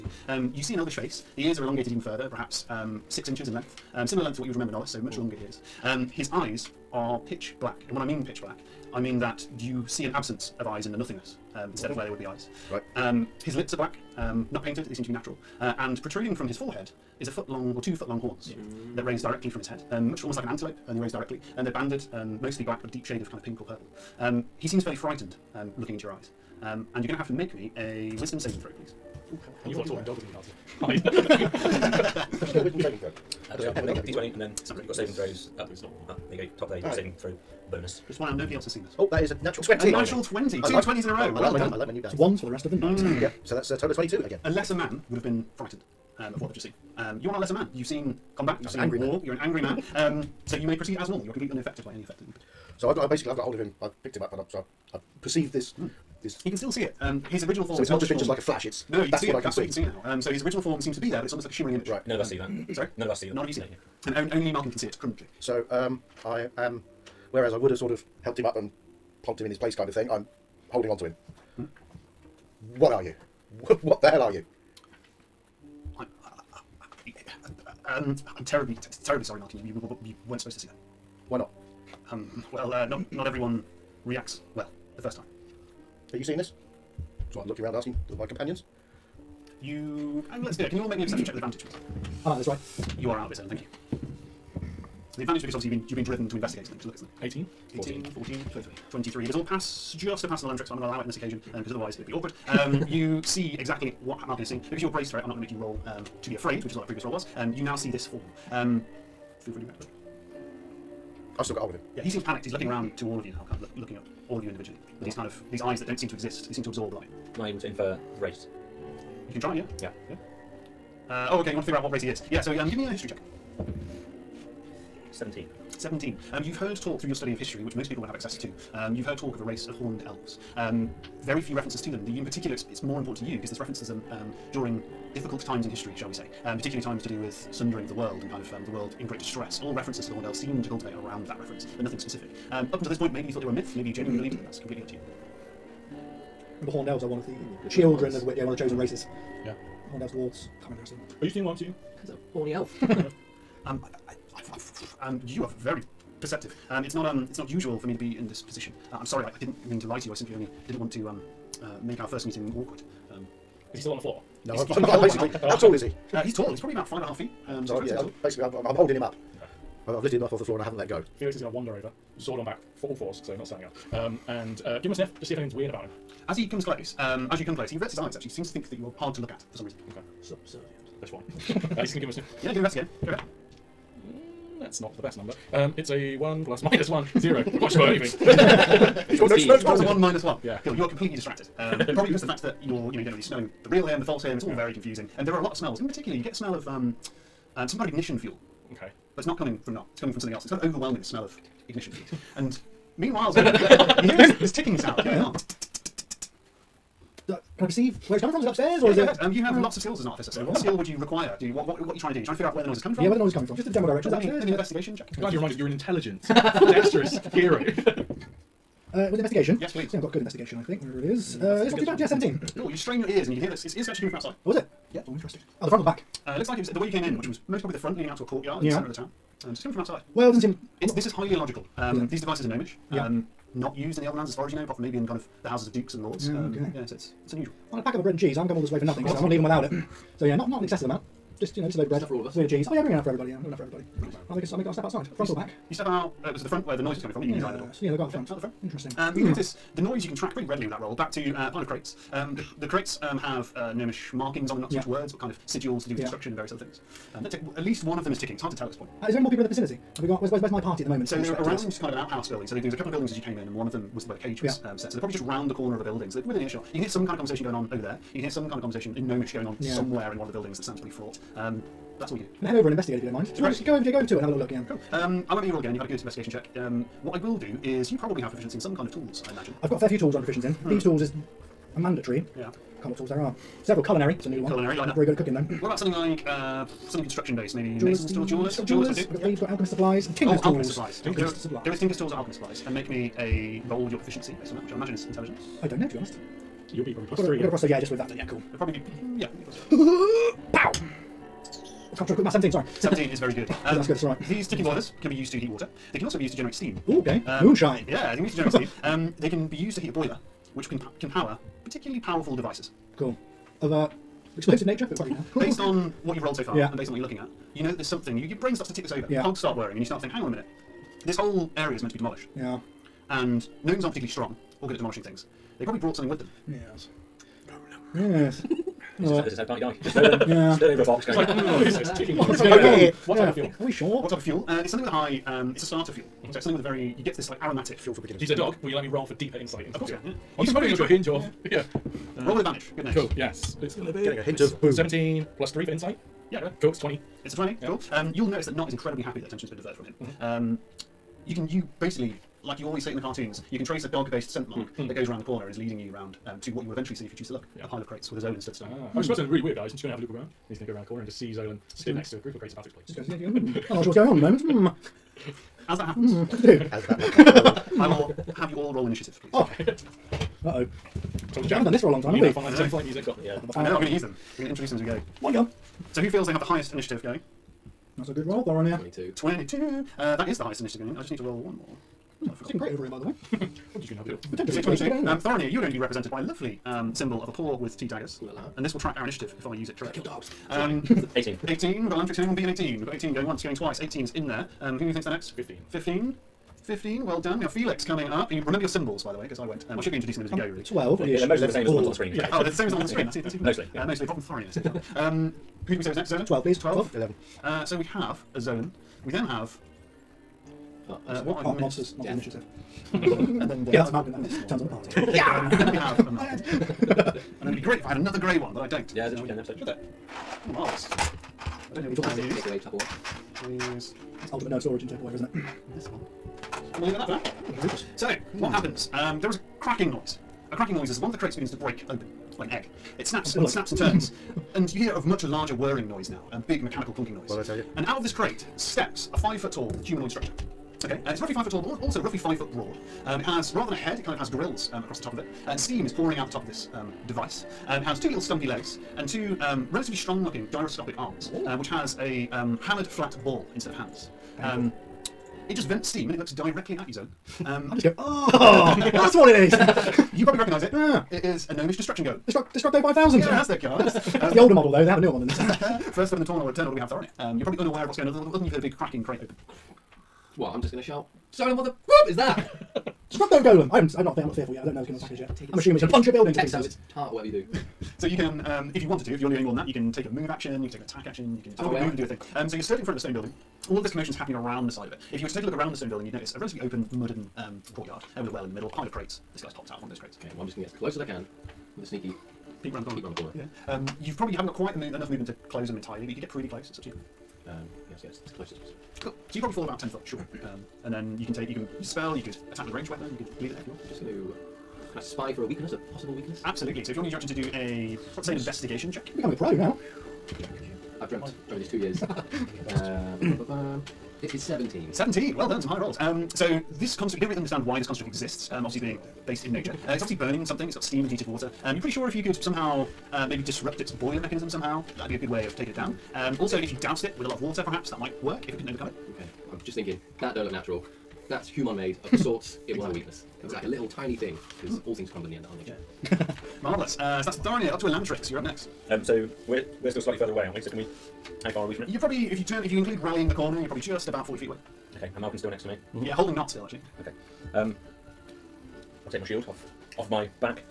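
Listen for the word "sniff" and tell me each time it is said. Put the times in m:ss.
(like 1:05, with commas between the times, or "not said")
2:54, 3:02.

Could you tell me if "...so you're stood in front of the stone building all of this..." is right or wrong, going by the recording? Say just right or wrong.
right.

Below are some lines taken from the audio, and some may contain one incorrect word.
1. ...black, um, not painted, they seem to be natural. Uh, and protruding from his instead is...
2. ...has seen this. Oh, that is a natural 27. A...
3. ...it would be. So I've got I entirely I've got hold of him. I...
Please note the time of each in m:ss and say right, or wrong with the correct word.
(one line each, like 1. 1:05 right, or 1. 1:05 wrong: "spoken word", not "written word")
1. 0:13 wrong: "forehead", not "instead"
2. 0:38 wrong: "20", not "27"
3. 0:52 wrong: "basically", not "entirely".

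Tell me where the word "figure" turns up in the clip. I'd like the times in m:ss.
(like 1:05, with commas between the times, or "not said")
2:01, 3:32.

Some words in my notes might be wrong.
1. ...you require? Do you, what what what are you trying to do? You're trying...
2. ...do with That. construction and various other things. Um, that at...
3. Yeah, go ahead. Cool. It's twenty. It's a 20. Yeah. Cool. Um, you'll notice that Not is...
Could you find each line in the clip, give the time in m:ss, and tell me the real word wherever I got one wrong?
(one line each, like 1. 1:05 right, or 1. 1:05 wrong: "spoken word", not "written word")
1. 3:30 right
2. 4:15 wrong: "Yeah", not "That"
3. 5:46 right.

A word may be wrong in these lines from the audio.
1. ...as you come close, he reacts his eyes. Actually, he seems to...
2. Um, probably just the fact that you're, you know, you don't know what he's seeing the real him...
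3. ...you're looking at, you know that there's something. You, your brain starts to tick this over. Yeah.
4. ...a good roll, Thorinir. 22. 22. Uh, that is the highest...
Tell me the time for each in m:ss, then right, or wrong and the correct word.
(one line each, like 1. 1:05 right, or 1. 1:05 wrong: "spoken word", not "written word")
1. 2:57 wrong: "averts", not "reacts"
2. 3:11 wrong: "smelling", not "seeing"
3. 5:16 right
4. 6:18 right.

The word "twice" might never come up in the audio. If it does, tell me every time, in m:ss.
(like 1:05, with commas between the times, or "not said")
6:33.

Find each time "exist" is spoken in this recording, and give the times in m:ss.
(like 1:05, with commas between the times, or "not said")
1:56, 8:38.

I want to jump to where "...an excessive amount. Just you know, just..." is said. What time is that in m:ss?
4:00.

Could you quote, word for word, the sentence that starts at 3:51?
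Um, is these devices are gnomish.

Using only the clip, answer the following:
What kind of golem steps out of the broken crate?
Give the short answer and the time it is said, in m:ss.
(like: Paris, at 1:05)
Gnomish destruction golem, at 7:41.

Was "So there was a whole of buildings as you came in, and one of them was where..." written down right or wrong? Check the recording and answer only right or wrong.
wrong.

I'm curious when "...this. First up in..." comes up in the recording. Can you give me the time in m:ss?
7:45.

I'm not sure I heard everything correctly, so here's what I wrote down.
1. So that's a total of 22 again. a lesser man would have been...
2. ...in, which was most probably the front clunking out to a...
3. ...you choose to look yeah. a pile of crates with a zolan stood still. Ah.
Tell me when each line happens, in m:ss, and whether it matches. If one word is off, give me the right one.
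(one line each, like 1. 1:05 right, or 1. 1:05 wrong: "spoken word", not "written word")
1. 0:43 right
2. 3:47 wrong: "leading", not "clunking"
3. 5:57 right.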